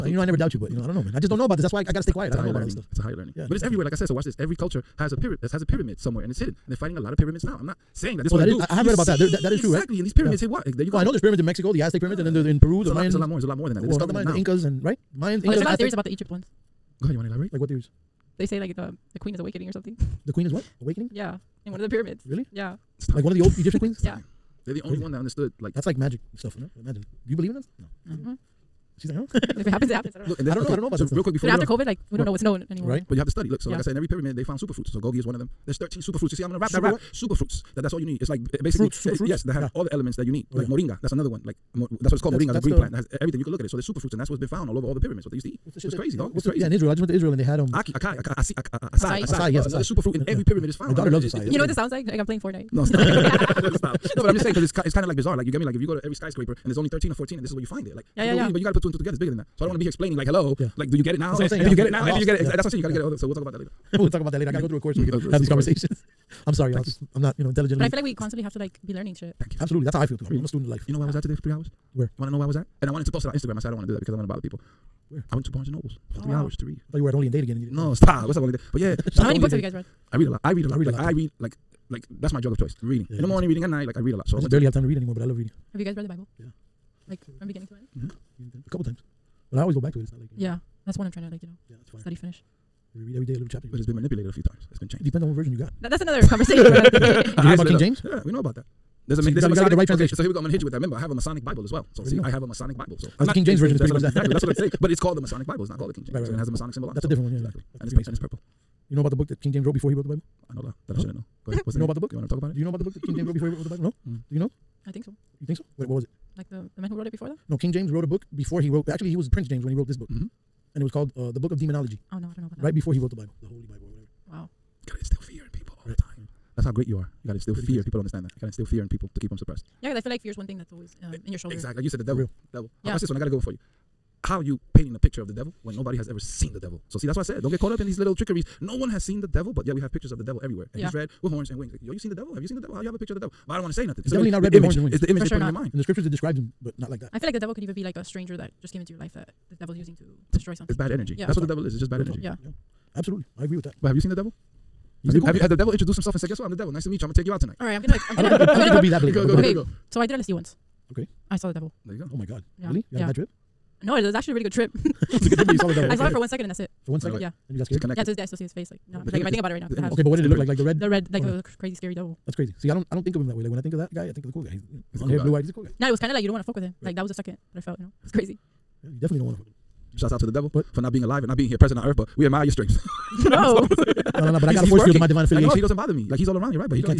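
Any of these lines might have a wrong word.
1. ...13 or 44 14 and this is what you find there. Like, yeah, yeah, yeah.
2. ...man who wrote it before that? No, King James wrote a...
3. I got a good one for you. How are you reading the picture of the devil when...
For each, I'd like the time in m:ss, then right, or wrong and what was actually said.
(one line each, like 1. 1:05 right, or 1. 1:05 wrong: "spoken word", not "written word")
1. 0:56 wrong: "14", not "44"
2. 1:56 right
3. 2:13 wrong: "painting", not "reading".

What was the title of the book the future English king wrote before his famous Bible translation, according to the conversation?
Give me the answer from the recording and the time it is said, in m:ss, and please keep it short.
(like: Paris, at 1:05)
Demonology, at 2:01.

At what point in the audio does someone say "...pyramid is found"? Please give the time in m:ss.
0:50.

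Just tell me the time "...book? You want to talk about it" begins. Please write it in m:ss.
1:51.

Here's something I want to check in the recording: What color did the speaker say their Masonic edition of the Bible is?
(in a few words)
Purple.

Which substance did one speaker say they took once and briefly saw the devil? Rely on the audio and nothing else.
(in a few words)
LSD.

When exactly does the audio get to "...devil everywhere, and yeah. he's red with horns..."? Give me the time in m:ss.
2:20.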